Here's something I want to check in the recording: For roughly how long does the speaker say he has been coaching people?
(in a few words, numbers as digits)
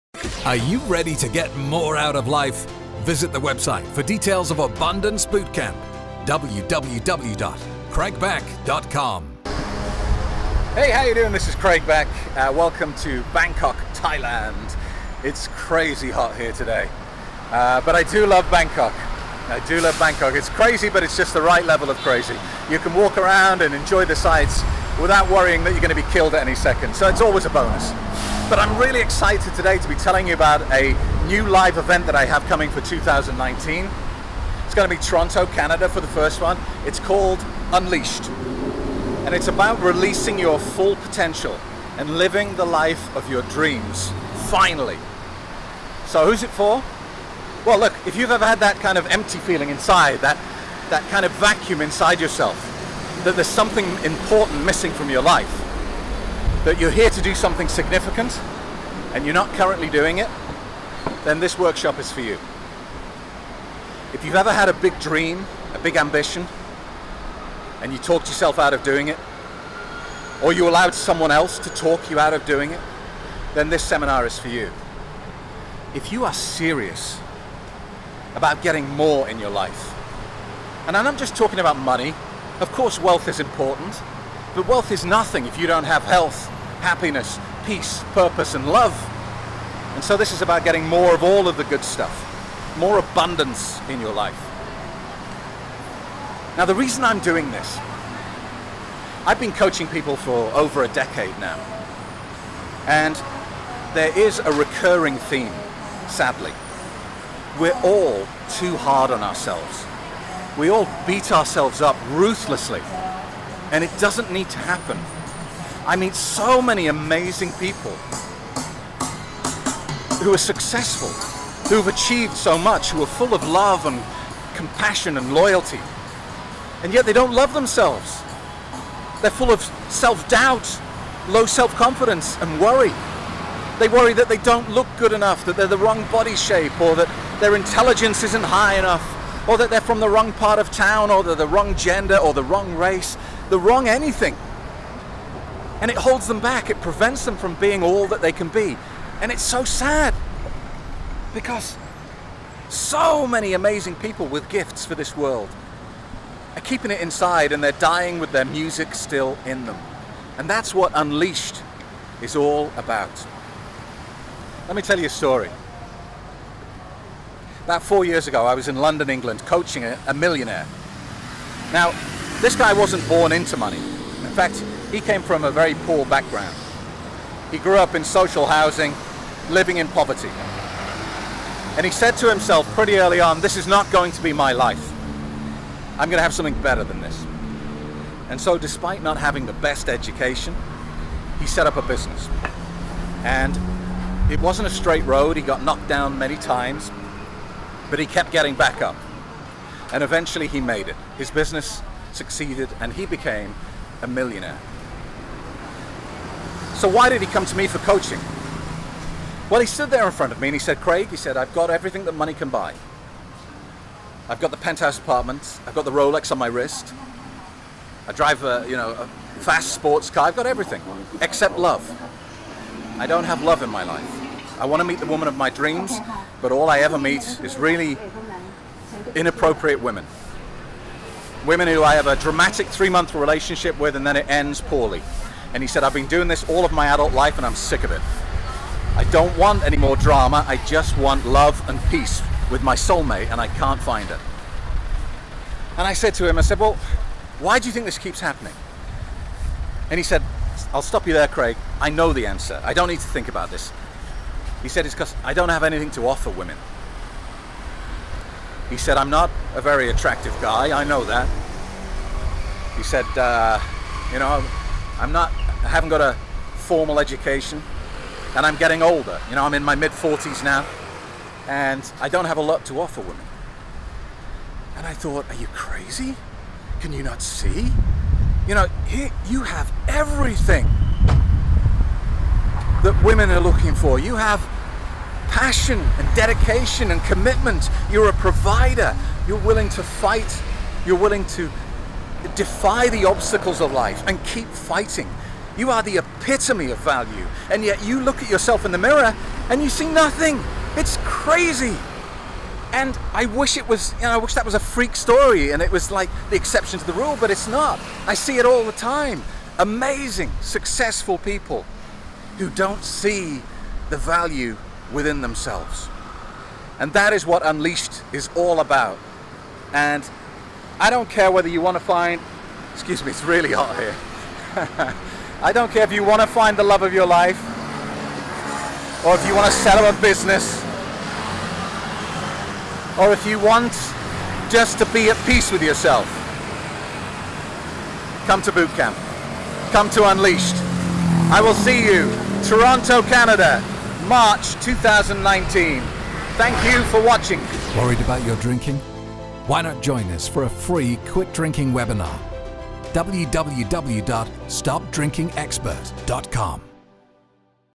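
Over a decade.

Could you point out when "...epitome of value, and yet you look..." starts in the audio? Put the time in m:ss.
4:55.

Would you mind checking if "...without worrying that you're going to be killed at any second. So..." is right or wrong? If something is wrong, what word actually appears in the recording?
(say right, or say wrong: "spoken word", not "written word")
right.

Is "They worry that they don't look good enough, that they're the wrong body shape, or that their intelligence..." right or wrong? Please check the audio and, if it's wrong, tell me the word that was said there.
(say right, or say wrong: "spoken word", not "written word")
right.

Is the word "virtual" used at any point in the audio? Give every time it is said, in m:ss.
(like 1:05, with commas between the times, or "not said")
not said.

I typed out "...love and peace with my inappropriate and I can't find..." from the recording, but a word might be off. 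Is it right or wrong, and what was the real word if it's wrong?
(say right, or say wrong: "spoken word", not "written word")
wrong: "soulmate", not "inappropriate".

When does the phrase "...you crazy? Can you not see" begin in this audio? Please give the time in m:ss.
4:35.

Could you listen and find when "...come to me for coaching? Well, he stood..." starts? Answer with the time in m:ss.
3:27.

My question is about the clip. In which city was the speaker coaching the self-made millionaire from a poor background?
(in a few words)
London.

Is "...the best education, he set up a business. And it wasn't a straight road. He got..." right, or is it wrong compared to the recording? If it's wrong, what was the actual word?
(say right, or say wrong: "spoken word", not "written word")
right.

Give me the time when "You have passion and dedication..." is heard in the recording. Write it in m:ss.
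4:43.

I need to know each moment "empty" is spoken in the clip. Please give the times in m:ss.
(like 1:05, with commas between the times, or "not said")
0:49.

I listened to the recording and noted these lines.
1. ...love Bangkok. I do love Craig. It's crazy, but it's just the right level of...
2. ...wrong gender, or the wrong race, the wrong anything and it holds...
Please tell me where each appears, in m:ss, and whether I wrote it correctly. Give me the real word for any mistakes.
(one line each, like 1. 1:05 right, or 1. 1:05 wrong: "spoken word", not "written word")
1. 0:18 wrong: "Bangkok", not "Craig"
2. 2:21 right.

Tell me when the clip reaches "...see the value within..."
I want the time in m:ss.
5:12.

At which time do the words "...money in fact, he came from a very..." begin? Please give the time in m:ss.
2:53.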